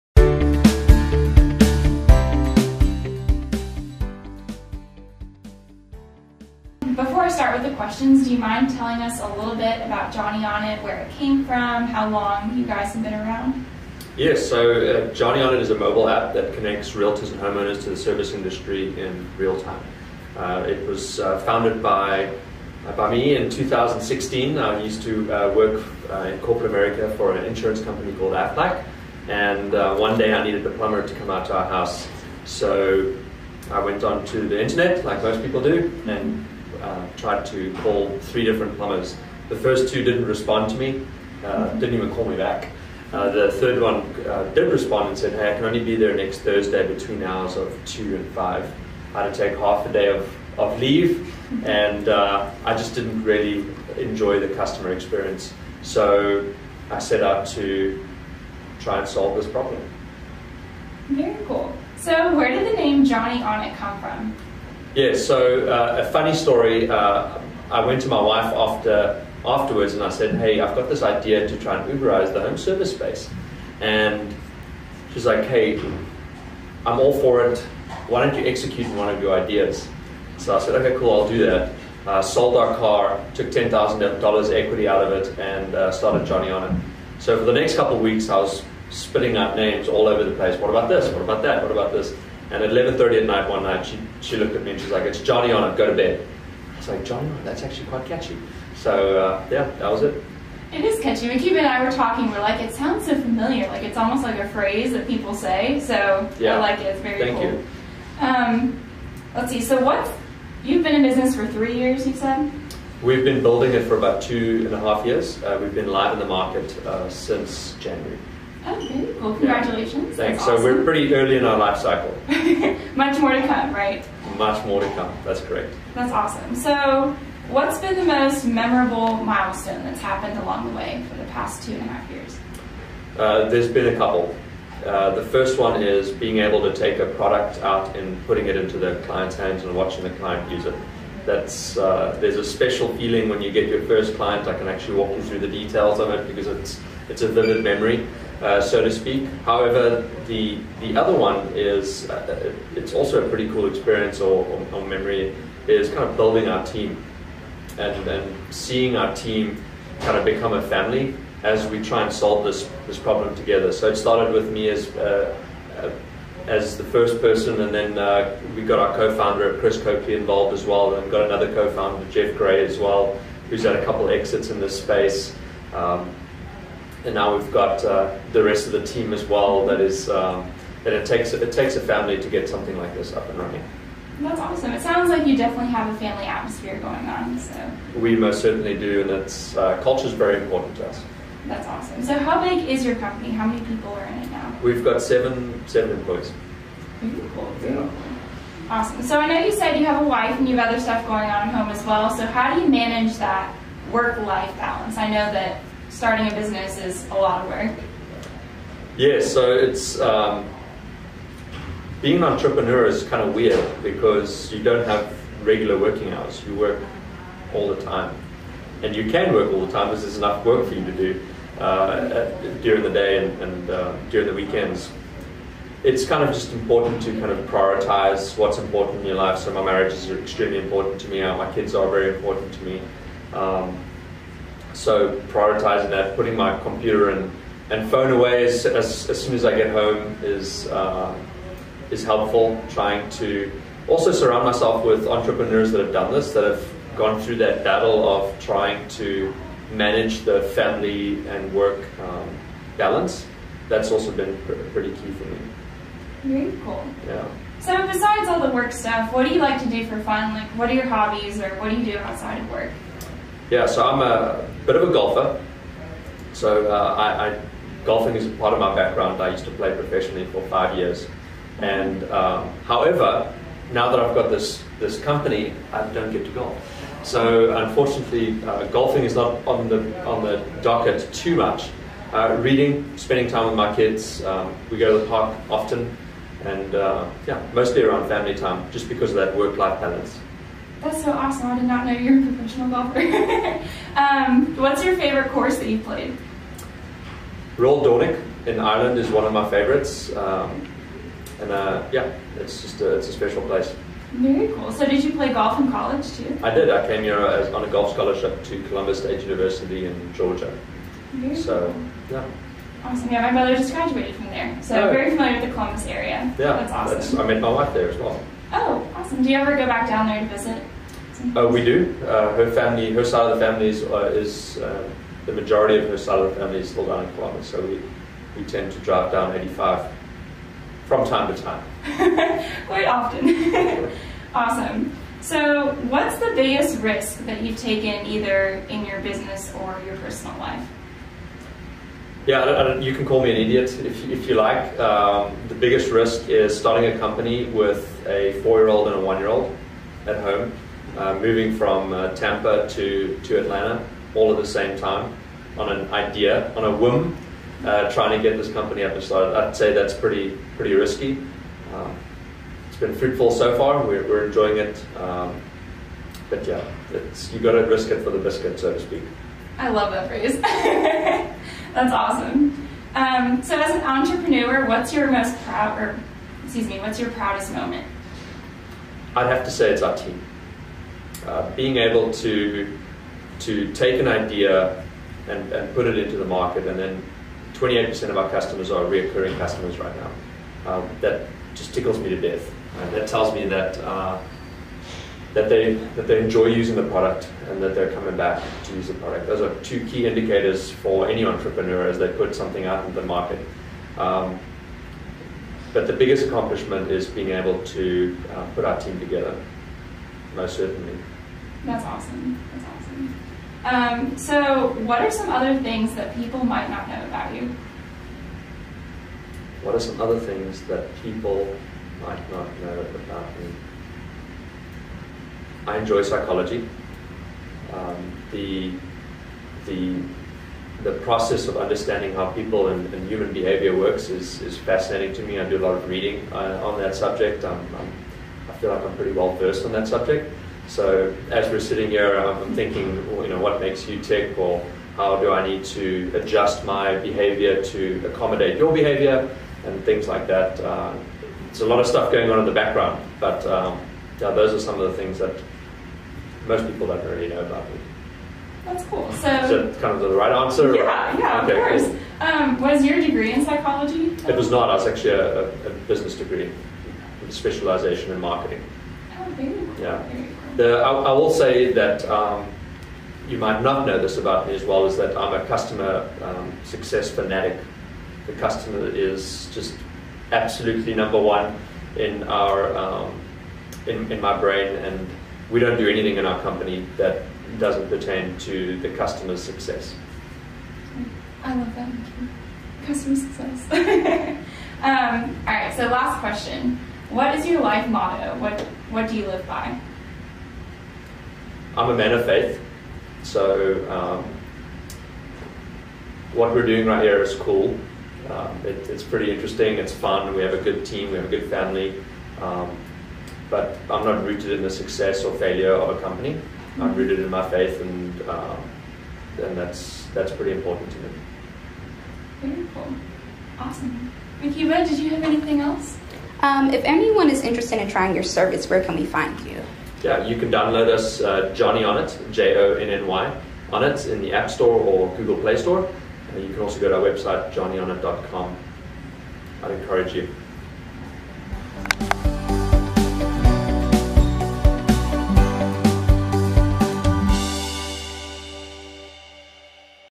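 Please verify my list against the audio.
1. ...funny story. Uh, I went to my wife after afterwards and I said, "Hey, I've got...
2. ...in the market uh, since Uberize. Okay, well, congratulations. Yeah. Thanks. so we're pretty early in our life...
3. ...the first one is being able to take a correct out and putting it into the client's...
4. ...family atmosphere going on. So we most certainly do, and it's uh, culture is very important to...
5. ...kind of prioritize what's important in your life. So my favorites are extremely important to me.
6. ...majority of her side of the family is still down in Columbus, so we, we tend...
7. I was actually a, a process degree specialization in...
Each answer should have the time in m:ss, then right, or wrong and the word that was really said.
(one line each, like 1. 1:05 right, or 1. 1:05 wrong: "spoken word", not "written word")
1. 1:06 right
2. 1:56 wrong: "January", not "Uberize"
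3. 2:15 wrong: "product", not "correct"
4. 3:05 right
5. 3:47 wrong: "marriages", not "favorites"
6. 5:25 right
7. 7:44 wrong: "business", not "process".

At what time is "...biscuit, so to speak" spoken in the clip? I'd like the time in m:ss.
6:08.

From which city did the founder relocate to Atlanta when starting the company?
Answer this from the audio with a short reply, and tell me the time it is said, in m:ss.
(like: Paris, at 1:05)
Tampa, at 5:52.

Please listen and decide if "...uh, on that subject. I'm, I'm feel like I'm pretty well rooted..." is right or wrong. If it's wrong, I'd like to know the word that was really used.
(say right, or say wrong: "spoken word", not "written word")
wrong: "versed", not "rooted".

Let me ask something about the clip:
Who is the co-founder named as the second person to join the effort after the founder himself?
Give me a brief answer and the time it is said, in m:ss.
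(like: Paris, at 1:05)
Chris Copley, at 2:49.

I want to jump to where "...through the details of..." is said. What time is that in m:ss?
2:25.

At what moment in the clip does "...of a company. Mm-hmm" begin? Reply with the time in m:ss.
8:35.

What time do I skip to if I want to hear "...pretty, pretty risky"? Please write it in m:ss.
5:59.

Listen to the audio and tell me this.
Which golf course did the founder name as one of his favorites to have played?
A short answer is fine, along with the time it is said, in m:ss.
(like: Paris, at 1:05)
Royal Dornoch, at 4:57.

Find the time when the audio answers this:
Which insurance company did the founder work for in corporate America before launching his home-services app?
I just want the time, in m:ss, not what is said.
0:28.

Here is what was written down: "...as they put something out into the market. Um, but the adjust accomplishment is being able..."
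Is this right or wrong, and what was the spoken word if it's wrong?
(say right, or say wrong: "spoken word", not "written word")
wrong: "biggest", not "adjust".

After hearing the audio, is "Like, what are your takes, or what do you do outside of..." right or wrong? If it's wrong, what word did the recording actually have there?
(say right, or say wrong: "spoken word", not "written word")
wrong: "hobbies", not "takes".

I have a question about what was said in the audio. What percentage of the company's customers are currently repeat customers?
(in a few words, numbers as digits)
28%.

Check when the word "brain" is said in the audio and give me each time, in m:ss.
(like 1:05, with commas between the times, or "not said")
8:04.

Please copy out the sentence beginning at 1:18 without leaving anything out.
Why don't you execute one of your ideas?" So I said, "Okay, cool.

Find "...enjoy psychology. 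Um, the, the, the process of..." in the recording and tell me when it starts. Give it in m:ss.
7:05.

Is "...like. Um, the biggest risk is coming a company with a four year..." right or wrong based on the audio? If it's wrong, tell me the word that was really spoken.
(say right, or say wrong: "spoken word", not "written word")
wrong: "starting", not "coming".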